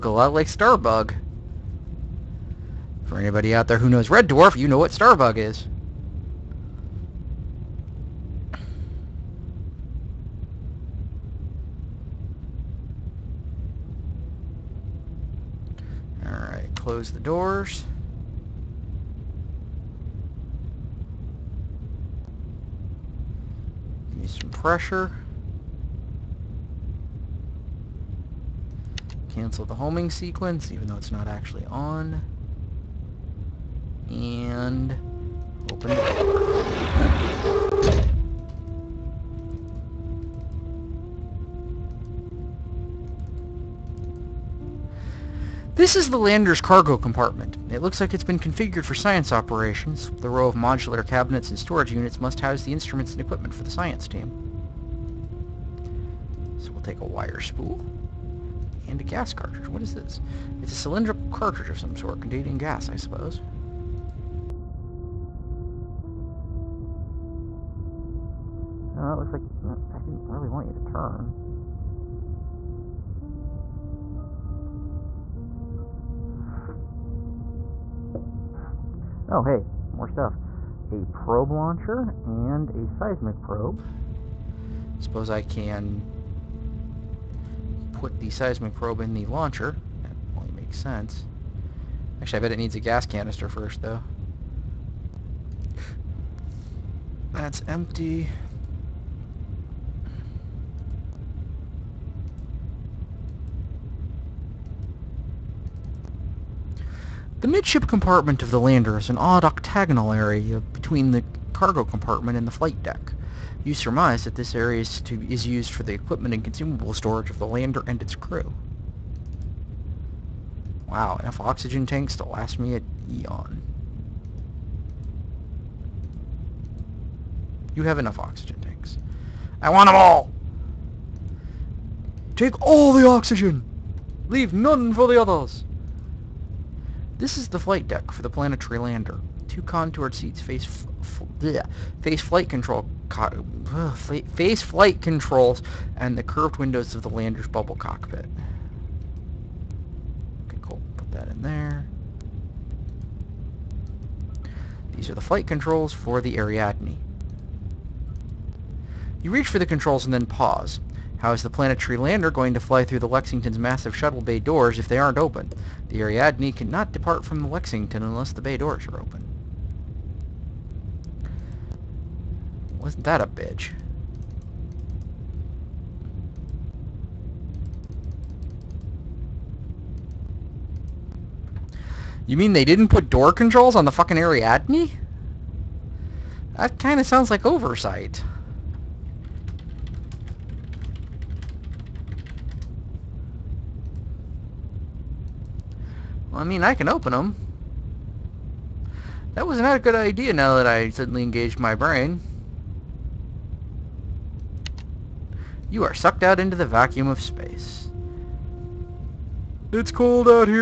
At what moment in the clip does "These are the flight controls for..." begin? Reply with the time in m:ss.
2:34.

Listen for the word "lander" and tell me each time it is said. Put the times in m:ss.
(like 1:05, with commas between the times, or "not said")
0:46, 1:48, 1:57, 2:18, 2:27, 2:41.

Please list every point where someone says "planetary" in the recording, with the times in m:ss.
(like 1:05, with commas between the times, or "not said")
2:18, 2:41.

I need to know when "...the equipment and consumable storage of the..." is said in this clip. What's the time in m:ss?
1:55.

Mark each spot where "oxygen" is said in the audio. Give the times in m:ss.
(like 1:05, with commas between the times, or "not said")
2:01, 2:08, 2:13.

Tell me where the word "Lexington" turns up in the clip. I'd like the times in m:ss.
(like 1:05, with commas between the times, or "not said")
2:43, 2:47.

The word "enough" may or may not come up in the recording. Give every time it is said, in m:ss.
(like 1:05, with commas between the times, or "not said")
2:01, 2:07.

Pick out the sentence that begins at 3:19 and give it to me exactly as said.
That was not a good idea now that I suddenly engaged my brain.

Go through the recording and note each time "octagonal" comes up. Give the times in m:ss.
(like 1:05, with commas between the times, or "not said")
1:49.